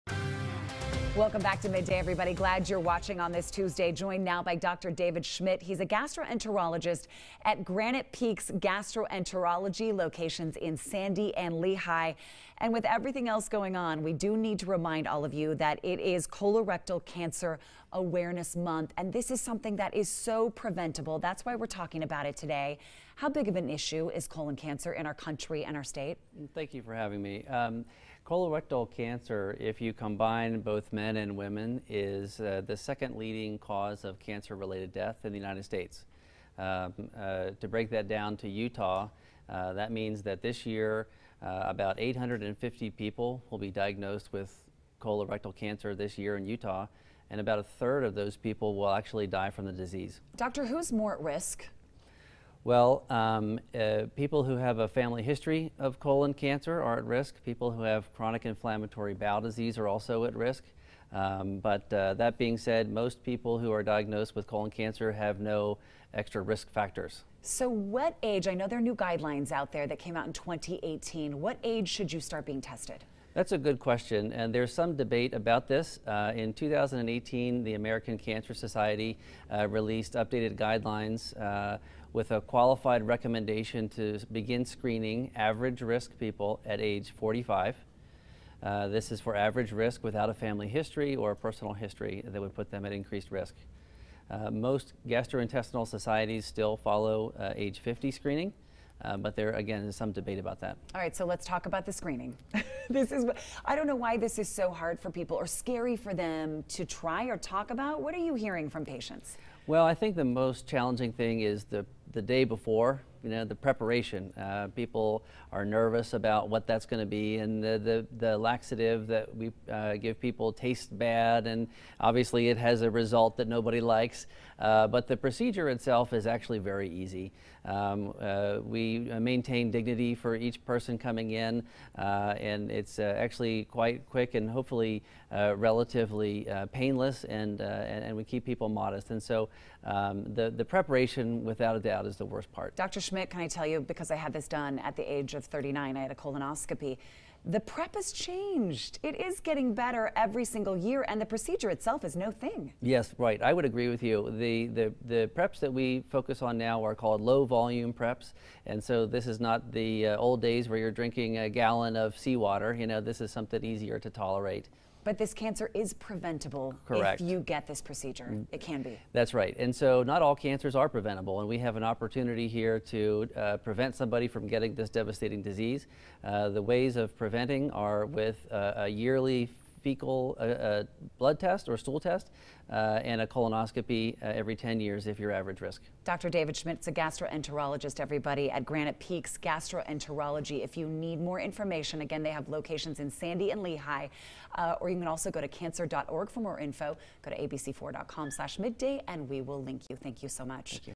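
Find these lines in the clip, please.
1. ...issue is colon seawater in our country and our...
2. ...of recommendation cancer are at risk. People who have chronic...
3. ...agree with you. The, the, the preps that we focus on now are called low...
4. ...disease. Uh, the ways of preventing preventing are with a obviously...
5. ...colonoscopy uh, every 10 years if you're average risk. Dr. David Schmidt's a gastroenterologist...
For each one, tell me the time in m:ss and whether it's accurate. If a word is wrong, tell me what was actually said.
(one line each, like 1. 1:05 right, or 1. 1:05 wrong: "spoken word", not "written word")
1. 0:23 wrong: "cancer", not "seawater"
2. 0:55 wrong: "colon", not "recommendation"
3. 2:33 right
4. 2:55 wrong: "yearly", not "obviously"
5. 3:03 right.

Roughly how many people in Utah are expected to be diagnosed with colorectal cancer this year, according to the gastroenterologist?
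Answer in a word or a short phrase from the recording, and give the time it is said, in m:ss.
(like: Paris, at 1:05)
850, at 0:41.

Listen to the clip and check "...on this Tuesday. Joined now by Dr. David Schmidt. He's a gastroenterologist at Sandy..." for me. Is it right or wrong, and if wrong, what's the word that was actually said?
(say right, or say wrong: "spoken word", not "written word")
wrong: "Granite", not "Sandy".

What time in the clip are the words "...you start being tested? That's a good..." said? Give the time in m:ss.
1:12.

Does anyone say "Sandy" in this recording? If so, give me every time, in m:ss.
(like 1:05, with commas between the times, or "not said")
0:10, 3:13.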